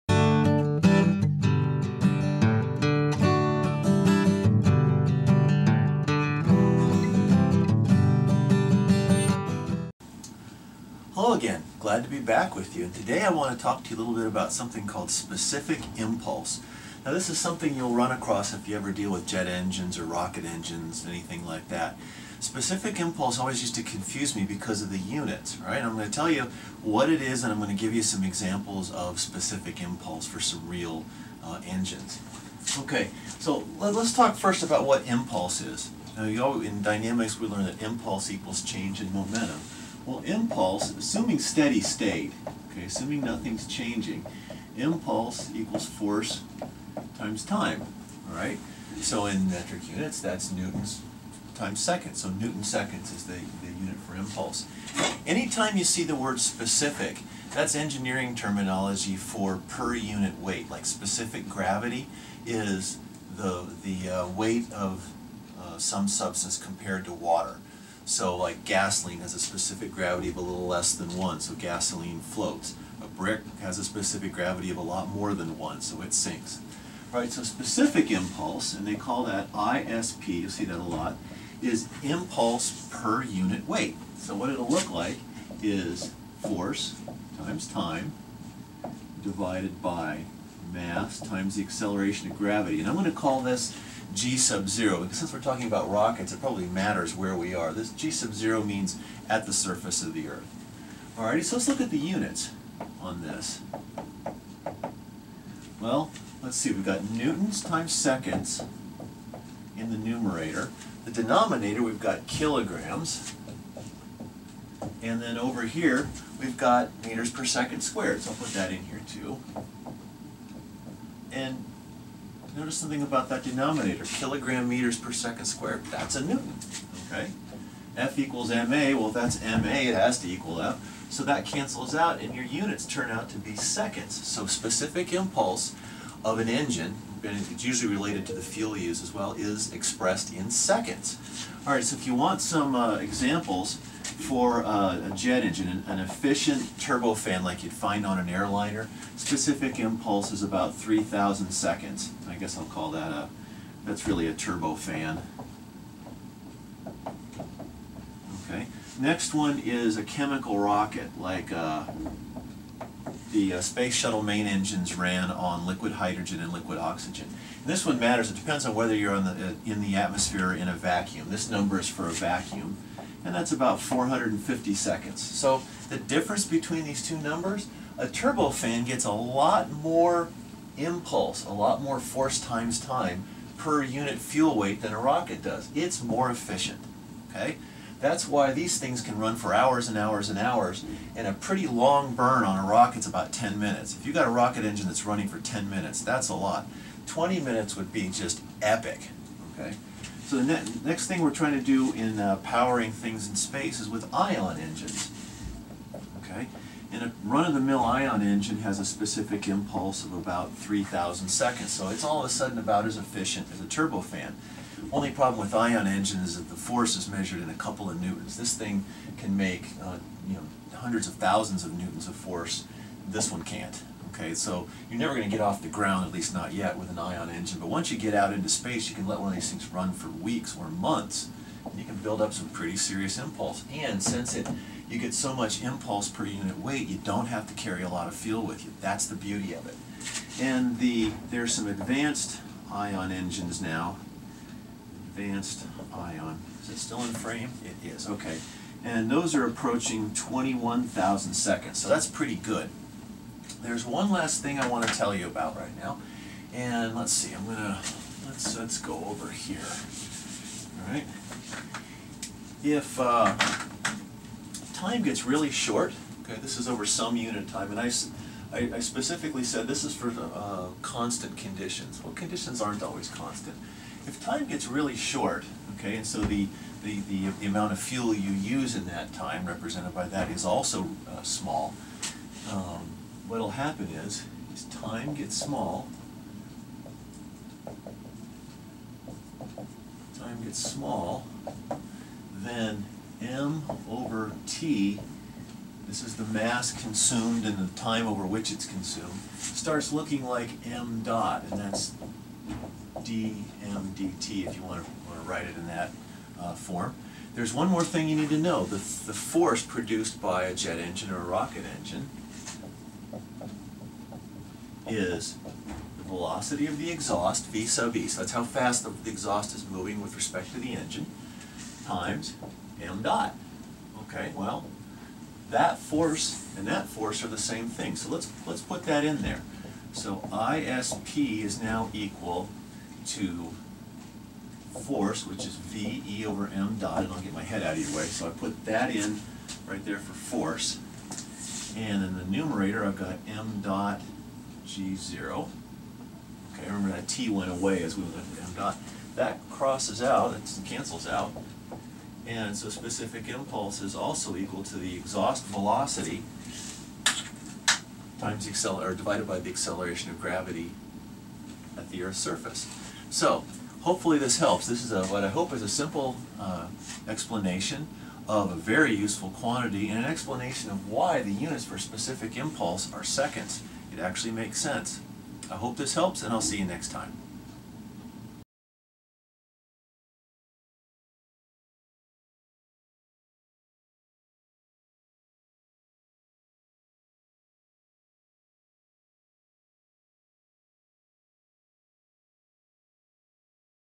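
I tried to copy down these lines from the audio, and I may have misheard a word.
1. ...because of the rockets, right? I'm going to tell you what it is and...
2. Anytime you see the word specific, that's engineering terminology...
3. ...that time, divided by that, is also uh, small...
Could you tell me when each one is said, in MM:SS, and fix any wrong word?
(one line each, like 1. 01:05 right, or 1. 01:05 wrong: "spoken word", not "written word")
1. 00:24 wrong: "units", not "rockets"
2. 00:55 right
3. 04:38 wrong: "represented", not "divided".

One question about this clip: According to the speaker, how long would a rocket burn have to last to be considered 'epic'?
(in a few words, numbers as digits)
20 minutes.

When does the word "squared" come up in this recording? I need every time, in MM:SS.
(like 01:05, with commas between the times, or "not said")
01:57, 02:05.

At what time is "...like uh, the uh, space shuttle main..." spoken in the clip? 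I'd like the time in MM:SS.
02:41.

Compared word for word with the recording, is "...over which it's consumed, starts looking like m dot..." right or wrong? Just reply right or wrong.
right.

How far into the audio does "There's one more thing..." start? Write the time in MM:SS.
05:07.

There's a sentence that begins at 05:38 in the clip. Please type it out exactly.
So I put that in right there for force.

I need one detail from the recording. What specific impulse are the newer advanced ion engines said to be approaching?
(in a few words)
21,000 seconds.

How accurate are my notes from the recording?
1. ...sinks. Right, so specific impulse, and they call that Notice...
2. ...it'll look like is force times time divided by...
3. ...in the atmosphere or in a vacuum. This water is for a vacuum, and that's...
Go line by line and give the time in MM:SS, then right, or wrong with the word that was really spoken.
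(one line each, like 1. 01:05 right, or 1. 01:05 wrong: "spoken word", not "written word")
1. 01:16 wrong: "ISP", not "Notice"
2. 01:24 right
3. 02:49 wrong: "number", not "water".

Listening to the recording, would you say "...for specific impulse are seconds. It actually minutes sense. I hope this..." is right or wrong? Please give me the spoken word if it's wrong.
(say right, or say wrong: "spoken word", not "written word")
wrong: "makes", not "minutes".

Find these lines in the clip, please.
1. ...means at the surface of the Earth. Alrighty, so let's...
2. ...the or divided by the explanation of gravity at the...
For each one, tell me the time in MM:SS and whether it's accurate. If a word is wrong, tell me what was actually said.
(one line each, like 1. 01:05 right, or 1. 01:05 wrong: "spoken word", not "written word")
1. 01:38 right
2. 05:58 wrong: "acceleration", not "explanation".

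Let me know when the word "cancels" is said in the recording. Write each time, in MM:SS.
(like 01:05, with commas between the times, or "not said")
02:11, 05:50.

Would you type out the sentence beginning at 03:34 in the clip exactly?
Only problem with ion engines is that the force is measured in a couple of newtons.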